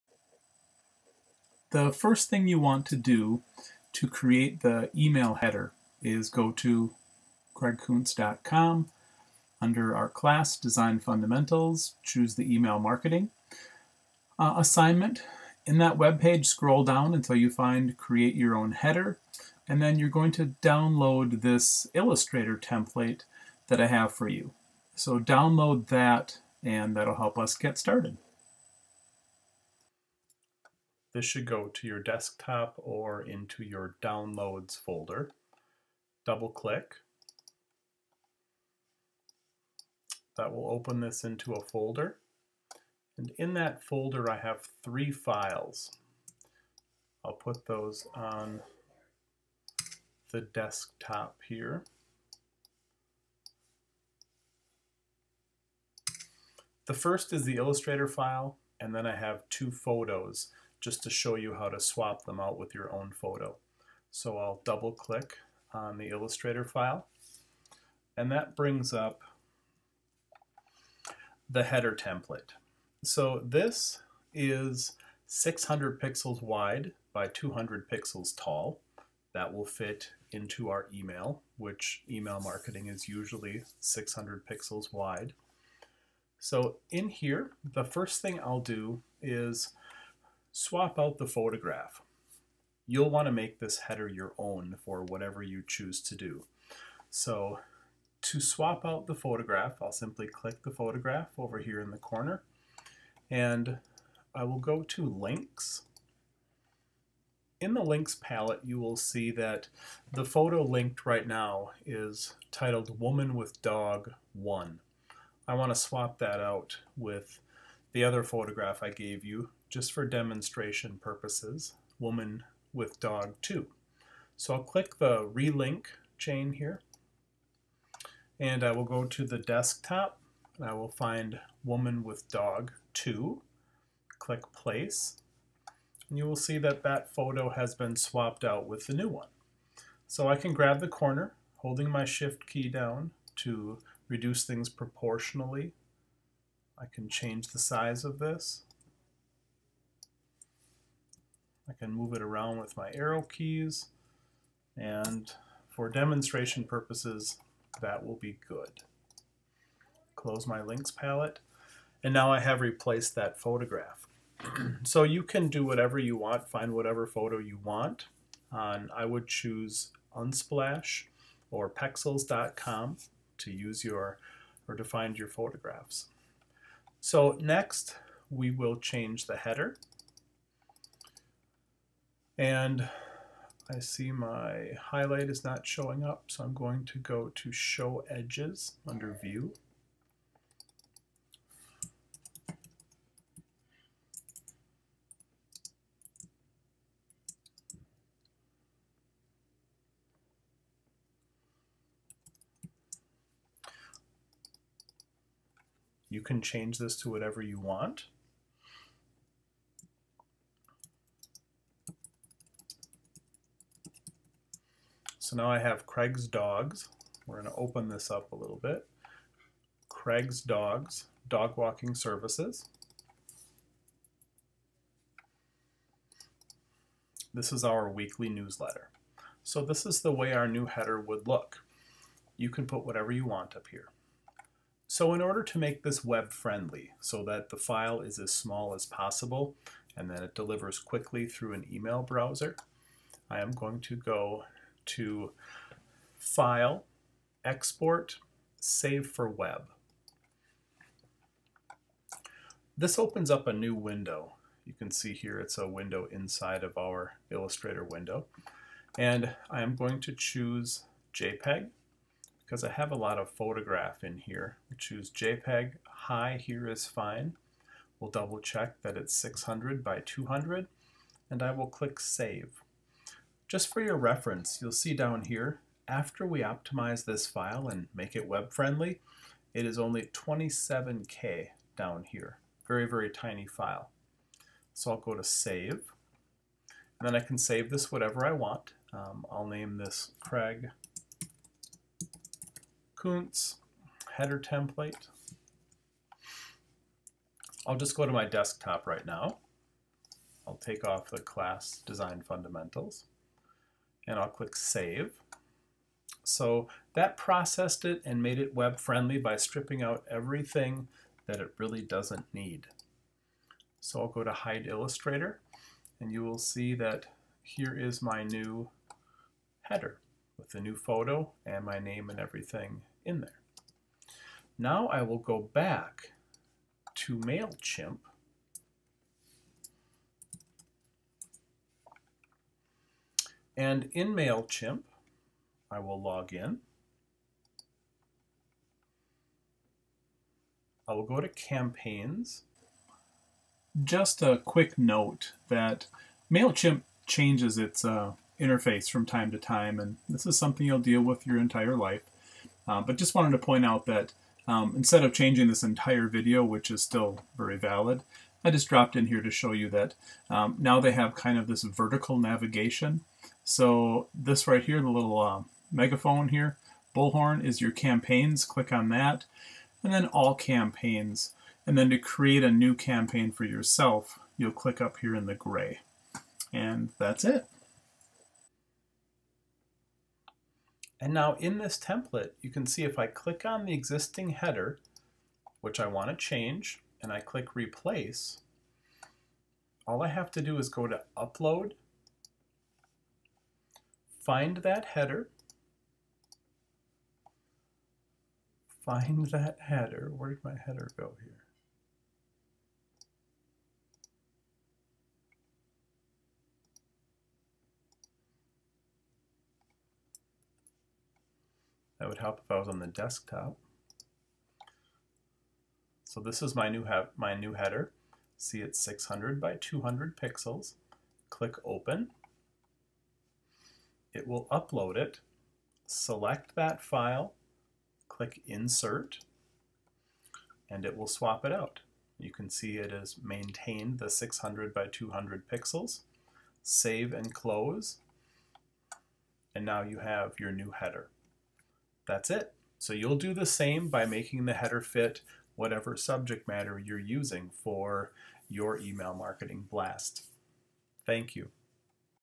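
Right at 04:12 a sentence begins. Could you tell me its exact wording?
This opens up a new window.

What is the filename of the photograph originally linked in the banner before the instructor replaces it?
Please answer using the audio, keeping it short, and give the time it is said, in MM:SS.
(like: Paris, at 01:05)
Woman with Dog 1, at 01:52.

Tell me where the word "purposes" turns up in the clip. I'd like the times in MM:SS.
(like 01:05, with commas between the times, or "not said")
02:01, 02:36.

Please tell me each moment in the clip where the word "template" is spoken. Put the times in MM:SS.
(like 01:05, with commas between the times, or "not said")
00:22, 01:11, 04:54, 06:21.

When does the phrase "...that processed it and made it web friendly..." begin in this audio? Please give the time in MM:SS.
05:06.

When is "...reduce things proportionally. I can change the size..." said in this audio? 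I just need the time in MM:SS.
02:24.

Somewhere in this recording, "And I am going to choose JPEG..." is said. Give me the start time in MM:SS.
04:18.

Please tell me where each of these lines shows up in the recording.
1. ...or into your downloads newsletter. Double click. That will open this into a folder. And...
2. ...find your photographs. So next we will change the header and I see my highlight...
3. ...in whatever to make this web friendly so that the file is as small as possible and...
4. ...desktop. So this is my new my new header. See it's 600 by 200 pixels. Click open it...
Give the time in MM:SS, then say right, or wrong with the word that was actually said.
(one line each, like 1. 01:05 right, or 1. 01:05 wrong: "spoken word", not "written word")
1. 00:32 wrong: "folder", not "newsletter"
2. 02:54 right
3. 03:55 wrong: "order", not "whatever"
4. 06:52 right.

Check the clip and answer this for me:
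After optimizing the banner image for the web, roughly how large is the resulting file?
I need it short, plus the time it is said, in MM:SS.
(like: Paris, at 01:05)
27K, at 04:40.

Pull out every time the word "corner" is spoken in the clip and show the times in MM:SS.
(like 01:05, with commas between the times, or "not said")
01:41, 02:20.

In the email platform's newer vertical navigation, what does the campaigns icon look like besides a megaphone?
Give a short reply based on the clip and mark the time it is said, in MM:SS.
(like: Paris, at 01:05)
bullhorn, at 06:06.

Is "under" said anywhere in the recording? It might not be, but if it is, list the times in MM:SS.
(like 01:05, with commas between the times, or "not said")
00:09, 03:08.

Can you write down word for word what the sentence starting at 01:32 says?
You'll want to make this header your own for whatever you choose to do.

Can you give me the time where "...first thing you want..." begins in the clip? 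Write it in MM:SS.
00:01.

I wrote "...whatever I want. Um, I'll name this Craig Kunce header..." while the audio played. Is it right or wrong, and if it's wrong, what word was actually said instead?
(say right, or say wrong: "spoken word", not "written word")
right.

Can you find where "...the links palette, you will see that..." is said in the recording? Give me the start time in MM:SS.
01:47.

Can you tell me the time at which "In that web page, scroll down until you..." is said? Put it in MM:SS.
00:15.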